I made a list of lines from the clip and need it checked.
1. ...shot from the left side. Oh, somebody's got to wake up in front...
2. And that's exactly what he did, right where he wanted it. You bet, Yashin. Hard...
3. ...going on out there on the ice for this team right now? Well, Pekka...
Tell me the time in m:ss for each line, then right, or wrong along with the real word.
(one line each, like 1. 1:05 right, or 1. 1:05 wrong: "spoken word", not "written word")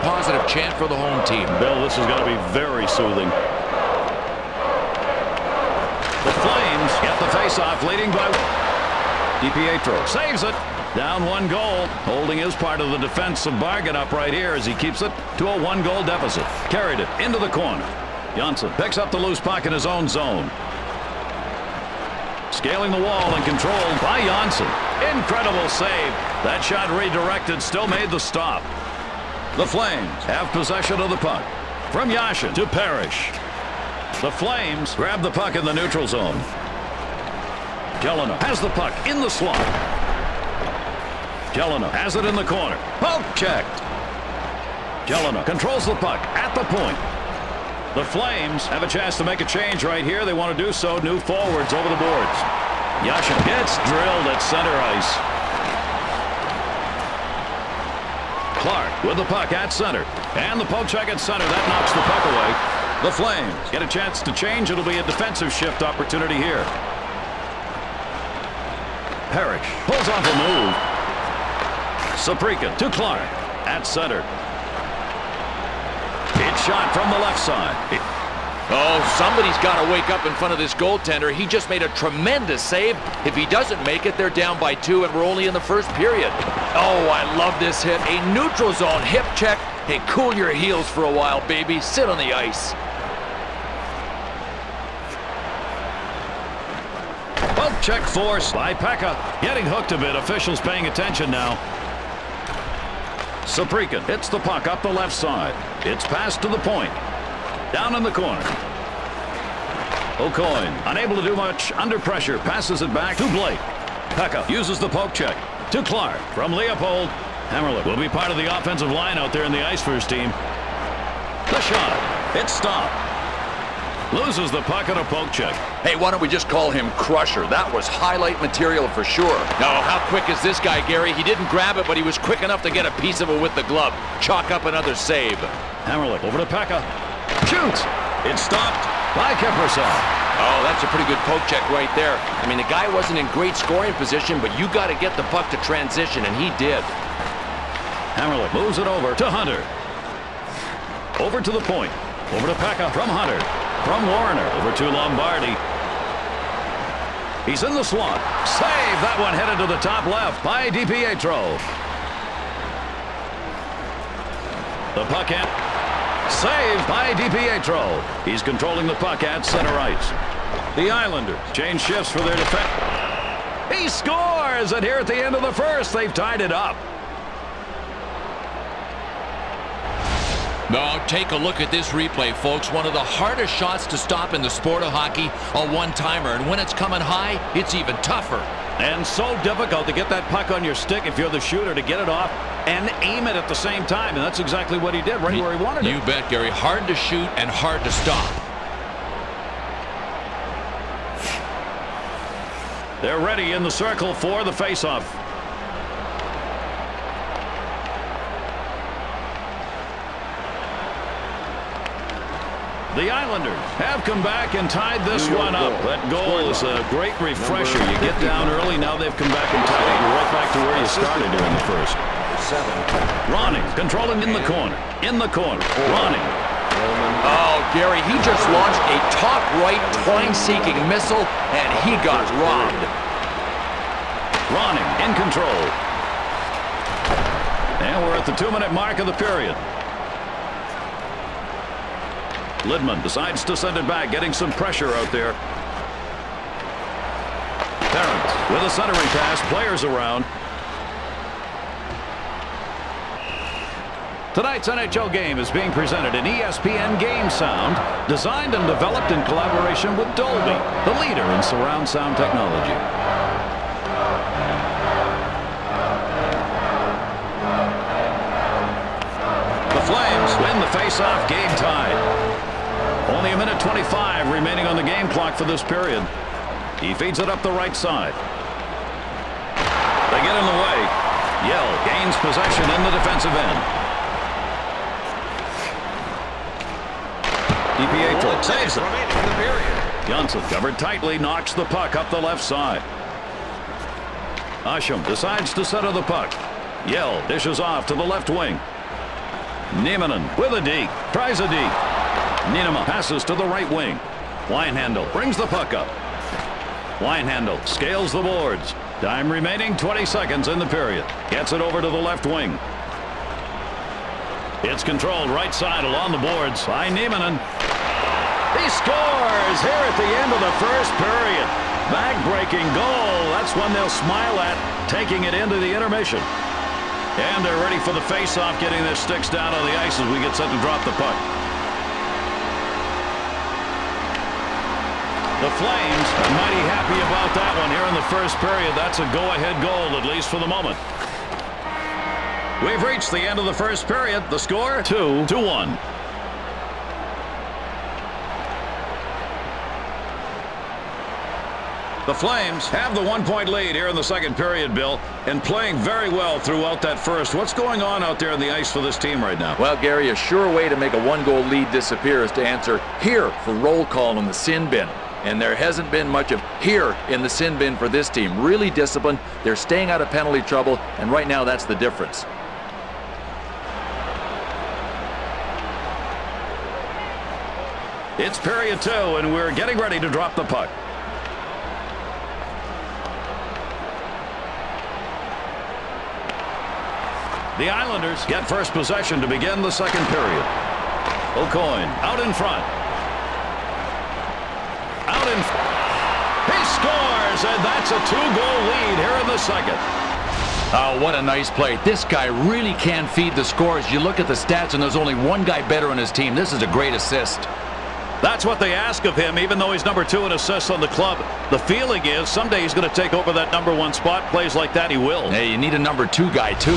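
1. 1:16 right
2. 3:14 wrong: "Gary", not "Yashin"
3. 5:57 wrong: "Gary", not "Pekka".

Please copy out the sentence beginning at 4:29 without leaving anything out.
The Flames win the face-off game tied.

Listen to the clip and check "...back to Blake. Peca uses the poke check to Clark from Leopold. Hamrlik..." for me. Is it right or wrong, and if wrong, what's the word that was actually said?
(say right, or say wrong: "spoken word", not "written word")
right.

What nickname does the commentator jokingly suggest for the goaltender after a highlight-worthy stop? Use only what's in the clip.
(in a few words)
Crusher.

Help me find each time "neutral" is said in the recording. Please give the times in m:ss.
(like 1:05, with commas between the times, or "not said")
0:35, 1:28.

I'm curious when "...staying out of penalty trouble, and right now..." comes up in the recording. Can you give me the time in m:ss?
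6:09.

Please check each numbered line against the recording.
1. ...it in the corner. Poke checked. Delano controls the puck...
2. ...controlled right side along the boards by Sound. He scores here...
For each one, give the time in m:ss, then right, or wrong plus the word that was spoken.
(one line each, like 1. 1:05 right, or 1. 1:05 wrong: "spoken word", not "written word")
1. 0:42 right
2. 5:14 wrong: "Nieminen", not "Sound".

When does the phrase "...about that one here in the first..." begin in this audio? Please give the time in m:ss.
5:37.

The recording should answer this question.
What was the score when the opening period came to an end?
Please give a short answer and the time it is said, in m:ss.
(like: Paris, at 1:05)
2 to 1, at 5:44.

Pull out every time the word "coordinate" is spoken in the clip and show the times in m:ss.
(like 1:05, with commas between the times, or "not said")
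not said.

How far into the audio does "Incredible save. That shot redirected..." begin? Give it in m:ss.
0:25.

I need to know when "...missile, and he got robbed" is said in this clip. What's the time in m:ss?
3:50.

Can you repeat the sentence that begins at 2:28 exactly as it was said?
Hamrlik moves it over to Hunter.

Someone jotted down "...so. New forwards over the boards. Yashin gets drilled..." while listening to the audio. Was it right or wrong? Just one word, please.
right.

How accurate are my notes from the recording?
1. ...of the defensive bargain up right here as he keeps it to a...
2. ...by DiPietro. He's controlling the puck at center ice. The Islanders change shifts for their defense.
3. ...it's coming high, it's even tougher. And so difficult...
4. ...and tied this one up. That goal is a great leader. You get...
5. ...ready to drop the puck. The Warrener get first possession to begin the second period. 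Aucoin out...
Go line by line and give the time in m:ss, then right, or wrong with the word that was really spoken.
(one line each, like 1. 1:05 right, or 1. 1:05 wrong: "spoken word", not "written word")
1. 0:12 right
2. 2:46 right
3. 3:06 right
4. 3:34 wrong: "refresher", not "leader"
5. 6:19 wrong: "Islanders", not "Warrener".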